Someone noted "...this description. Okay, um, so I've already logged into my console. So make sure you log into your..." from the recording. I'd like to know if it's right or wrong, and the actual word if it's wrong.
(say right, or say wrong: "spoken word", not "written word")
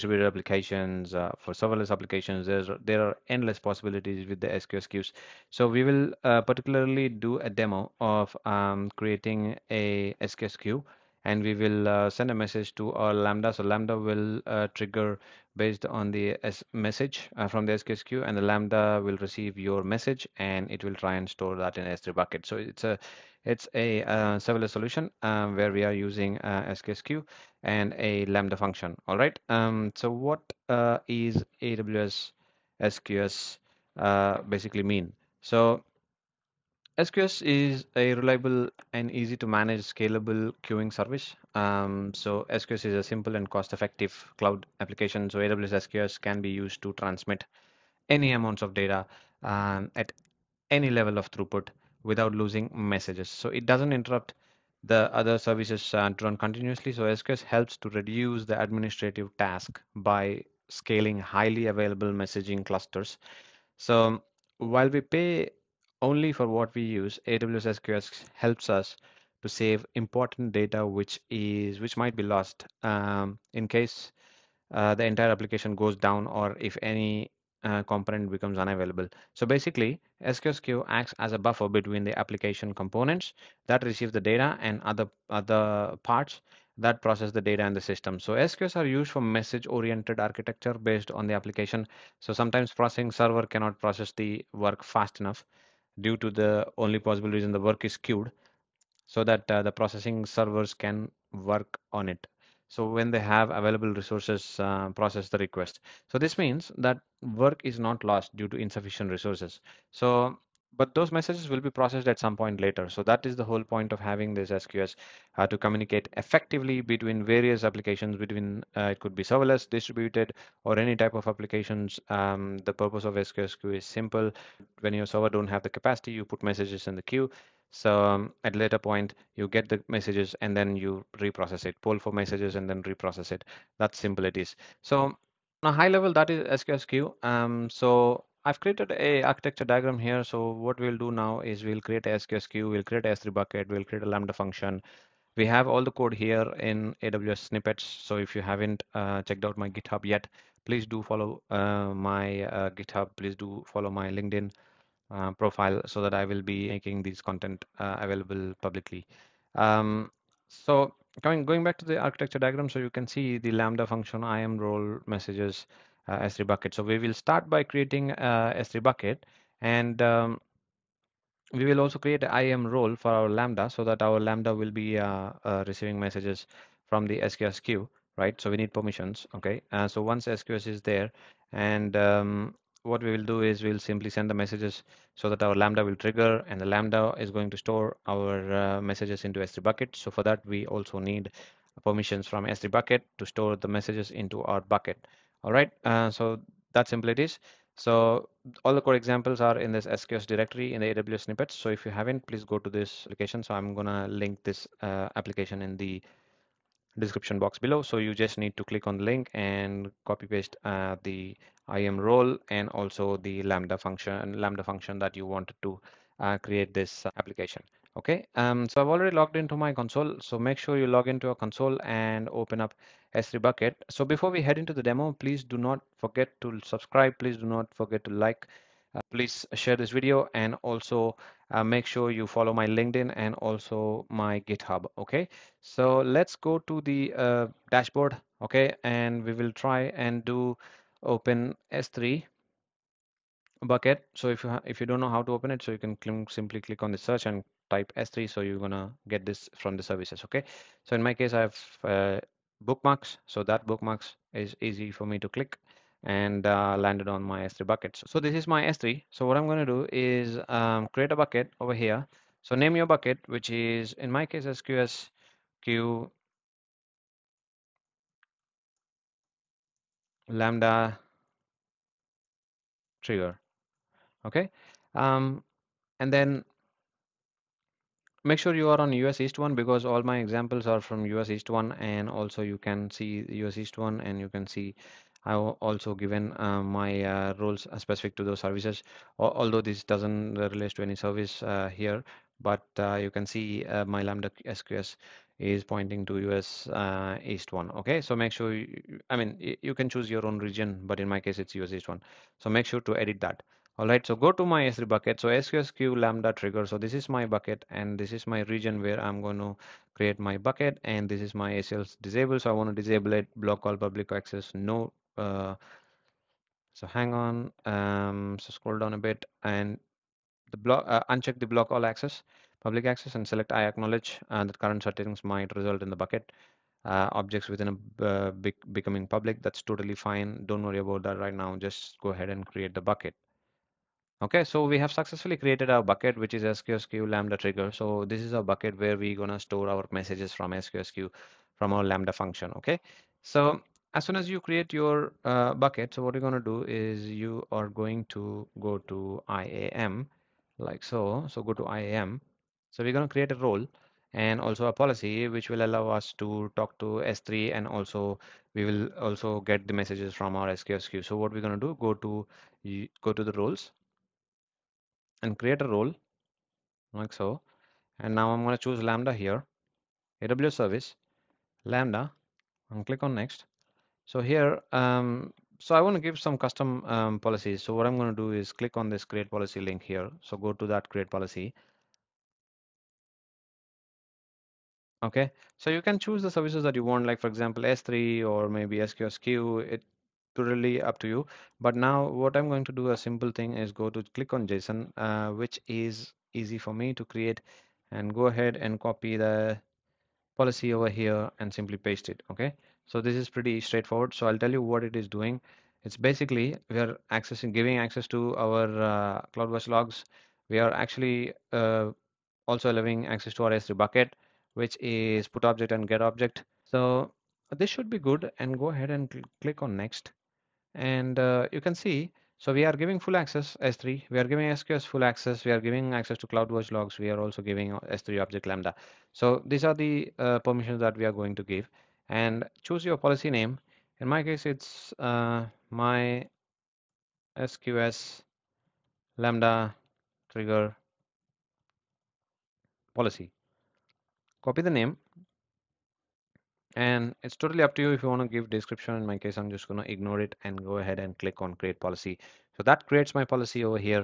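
wrong: "application", not "description".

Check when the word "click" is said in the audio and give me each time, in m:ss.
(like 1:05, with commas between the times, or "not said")
3:28, 4:06, 4:15, 6:12, 6:18, 6:34, 6:59, 7:31.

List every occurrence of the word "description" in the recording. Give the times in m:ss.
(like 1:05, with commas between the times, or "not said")
3:26, 7:28.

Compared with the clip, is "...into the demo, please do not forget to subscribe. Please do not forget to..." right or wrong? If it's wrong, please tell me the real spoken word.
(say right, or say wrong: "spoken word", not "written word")
right.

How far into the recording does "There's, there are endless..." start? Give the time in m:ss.
0:02.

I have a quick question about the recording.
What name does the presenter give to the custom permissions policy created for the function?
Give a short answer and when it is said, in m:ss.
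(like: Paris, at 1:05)
my SQS lambda trigger policy, at 7:15.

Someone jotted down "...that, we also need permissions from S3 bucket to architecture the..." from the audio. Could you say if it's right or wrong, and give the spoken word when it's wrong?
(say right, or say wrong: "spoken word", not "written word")
wrong: "store", not "architecture".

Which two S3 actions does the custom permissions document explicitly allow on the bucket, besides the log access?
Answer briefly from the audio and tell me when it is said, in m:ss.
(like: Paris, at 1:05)
put object and get object, at 6:55.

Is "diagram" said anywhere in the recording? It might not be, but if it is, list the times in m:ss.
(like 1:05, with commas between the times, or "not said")
2:19, 2:42.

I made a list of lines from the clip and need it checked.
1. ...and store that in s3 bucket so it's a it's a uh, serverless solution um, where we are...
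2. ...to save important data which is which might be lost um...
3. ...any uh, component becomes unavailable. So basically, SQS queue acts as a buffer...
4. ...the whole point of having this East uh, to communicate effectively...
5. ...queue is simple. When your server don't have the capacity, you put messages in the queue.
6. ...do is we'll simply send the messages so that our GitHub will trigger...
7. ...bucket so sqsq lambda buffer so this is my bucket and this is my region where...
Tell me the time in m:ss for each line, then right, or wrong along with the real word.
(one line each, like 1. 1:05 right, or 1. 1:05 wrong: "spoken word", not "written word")
1. 0:21 right
2. 1:09 right
3. 1:16 right
4. 1:53 wrong: "SQS", not "East"
5. 2:03 right
6. 3:03 wrong: "Lambda", not "GitHub"
7. 5:04 wrong: "trigger", not "buffer".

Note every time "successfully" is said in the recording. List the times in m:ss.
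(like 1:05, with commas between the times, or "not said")
5:34.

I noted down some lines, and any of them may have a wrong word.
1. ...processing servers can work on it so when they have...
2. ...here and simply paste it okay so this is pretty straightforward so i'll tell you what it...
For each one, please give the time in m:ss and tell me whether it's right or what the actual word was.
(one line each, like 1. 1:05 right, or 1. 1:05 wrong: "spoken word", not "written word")
1. 1:39 right
2. 6:40 right.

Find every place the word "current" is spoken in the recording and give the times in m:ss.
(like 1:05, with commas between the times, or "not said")
5:24.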